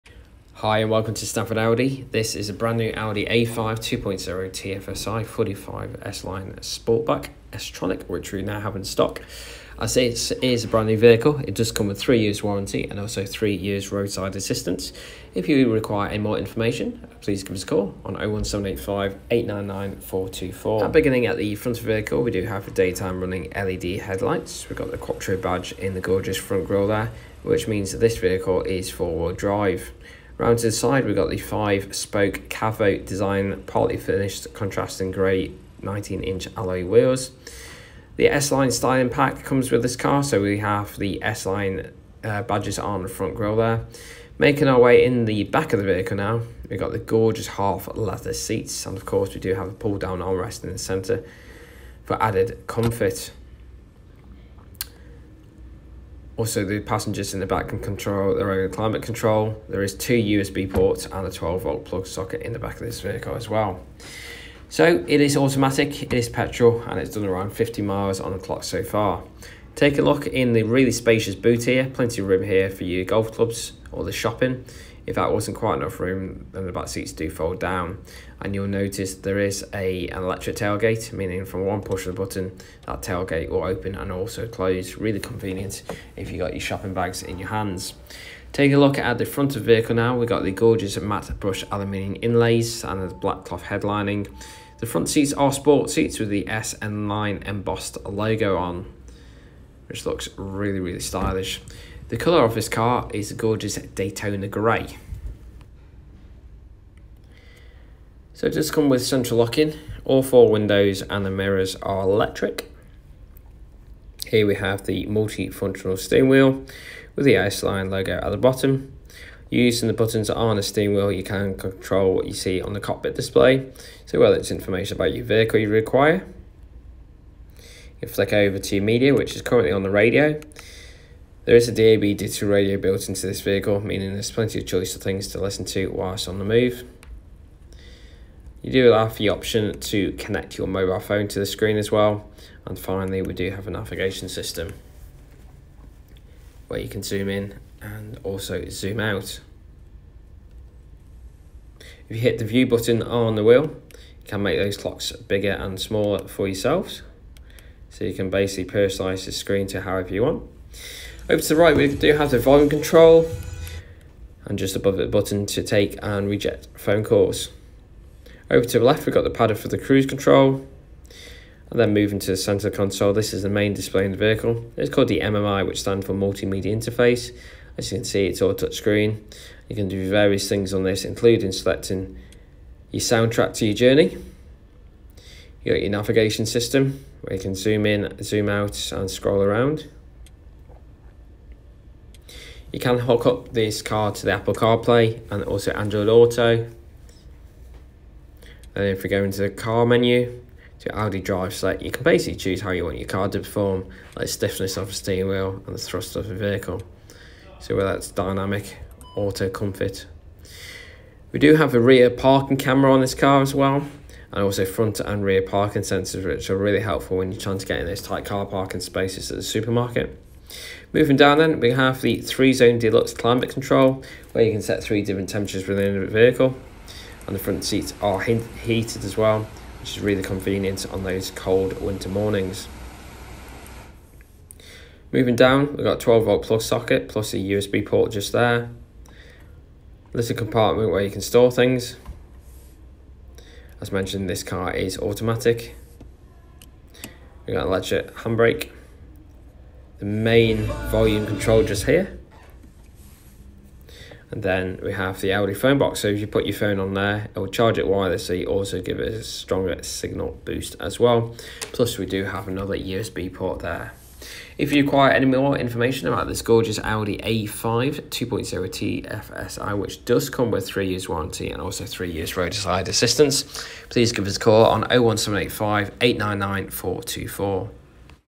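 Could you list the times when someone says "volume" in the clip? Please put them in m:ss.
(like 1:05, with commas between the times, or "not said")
2:42, 4:10.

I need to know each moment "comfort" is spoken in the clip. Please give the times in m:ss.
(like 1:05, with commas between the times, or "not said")
0:52, 3:29.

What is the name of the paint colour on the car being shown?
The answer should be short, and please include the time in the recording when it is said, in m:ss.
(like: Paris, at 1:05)
Daytona Grey, at 1:43.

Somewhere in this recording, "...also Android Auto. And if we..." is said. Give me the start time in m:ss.
3:15.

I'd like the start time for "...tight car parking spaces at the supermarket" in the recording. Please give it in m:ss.
3:38.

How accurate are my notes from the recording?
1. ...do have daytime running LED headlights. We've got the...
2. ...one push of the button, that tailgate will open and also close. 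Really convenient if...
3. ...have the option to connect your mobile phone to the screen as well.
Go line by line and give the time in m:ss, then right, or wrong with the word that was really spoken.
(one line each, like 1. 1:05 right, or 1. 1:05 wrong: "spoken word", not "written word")
1. 0:22 right
2. 1:21 right
3. 2:18 right.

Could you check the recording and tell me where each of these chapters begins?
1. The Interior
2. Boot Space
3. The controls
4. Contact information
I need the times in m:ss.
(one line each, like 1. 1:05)
1. 0:43
2. 1:00
3. 1:40
4. 4:23.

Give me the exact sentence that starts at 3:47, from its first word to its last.
And the front seats are heated as well, which is really convenient on those cold winter mornings.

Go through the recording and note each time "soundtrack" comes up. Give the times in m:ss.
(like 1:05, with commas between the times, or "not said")
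3:02.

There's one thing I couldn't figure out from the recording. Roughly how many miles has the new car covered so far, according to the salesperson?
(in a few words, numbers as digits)
50 miles.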